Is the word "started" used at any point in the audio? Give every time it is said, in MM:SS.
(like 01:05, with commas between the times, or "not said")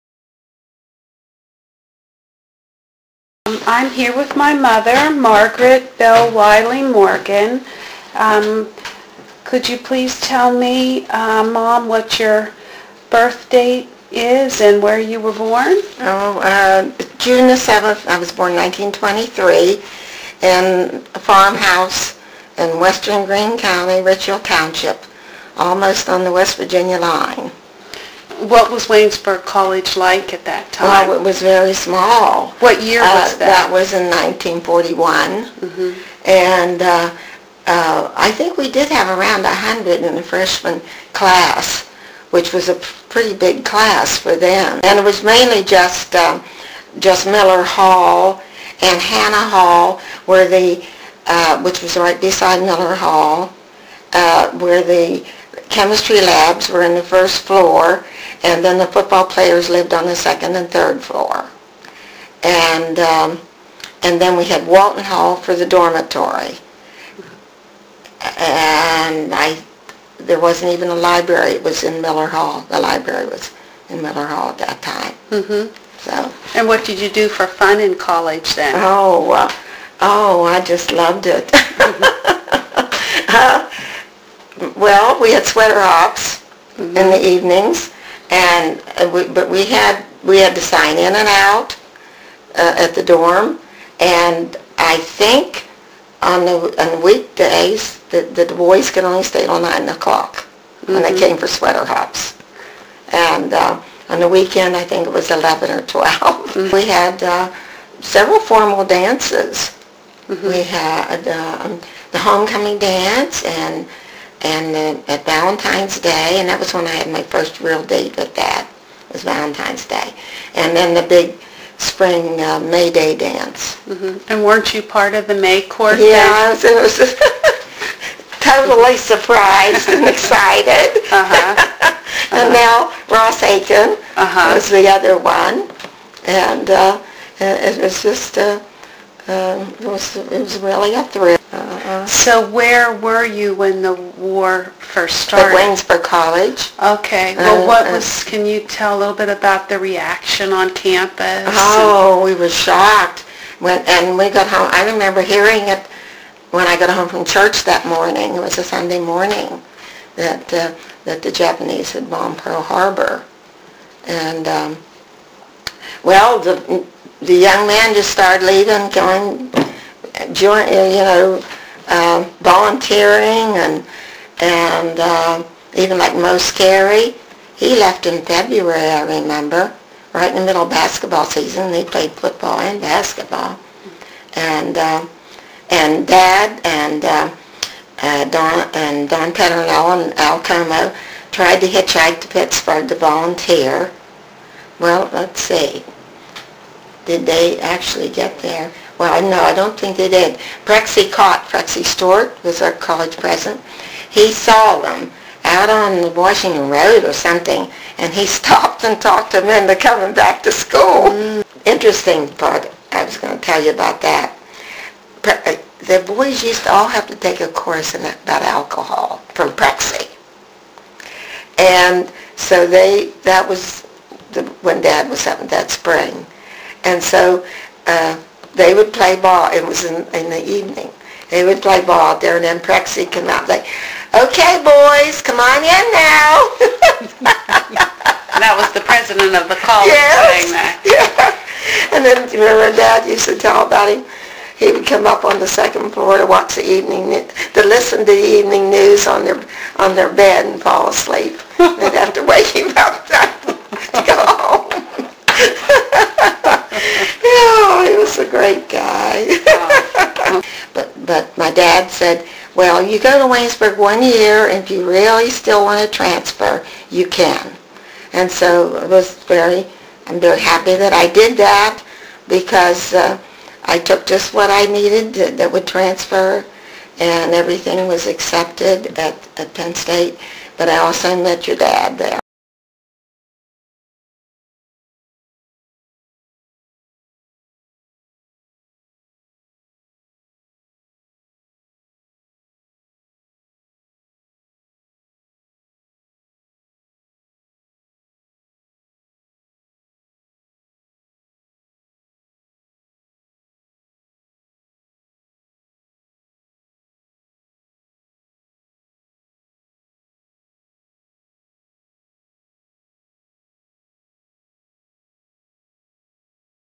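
02:25, 02:48.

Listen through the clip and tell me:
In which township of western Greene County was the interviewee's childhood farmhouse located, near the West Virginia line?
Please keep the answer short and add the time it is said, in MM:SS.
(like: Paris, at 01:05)
Richfield Township, at 00:24.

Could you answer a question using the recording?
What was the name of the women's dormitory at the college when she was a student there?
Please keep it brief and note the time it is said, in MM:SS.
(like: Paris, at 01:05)
Walton Hall, at 01:04.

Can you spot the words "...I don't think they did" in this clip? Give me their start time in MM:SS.
03:19.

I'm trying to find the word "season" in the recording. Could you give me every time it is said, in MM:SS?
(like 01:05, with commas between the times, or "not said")
03:01.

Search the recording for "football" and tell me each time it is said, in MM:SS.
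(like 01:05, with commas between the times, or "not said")
00:58, 03:02.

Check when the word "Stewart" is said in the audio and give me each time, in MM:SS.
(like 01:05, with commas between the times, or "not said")
03:21.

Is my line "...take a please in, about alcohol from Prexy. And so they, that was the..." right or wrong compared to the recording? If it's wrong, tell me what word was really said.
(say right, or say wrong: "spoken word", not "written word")
wrong: "course", not "please".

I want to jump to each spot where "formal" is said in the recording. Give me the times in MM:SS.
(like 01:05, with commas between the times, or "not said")
01:48.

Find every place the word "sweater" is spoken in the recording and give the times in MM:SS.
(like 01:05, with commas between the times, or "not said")
01:25, 01:41.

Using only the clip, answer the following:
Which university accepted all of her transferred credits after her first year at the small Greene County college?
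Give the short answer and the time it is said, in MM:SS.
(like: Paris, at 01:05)
Penn State, at 04:39.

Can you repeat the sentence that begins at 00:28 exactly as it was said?
What was Waynesburg College like at that time?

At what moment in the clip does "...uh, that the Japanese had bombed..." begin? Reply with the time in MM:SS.
02:40.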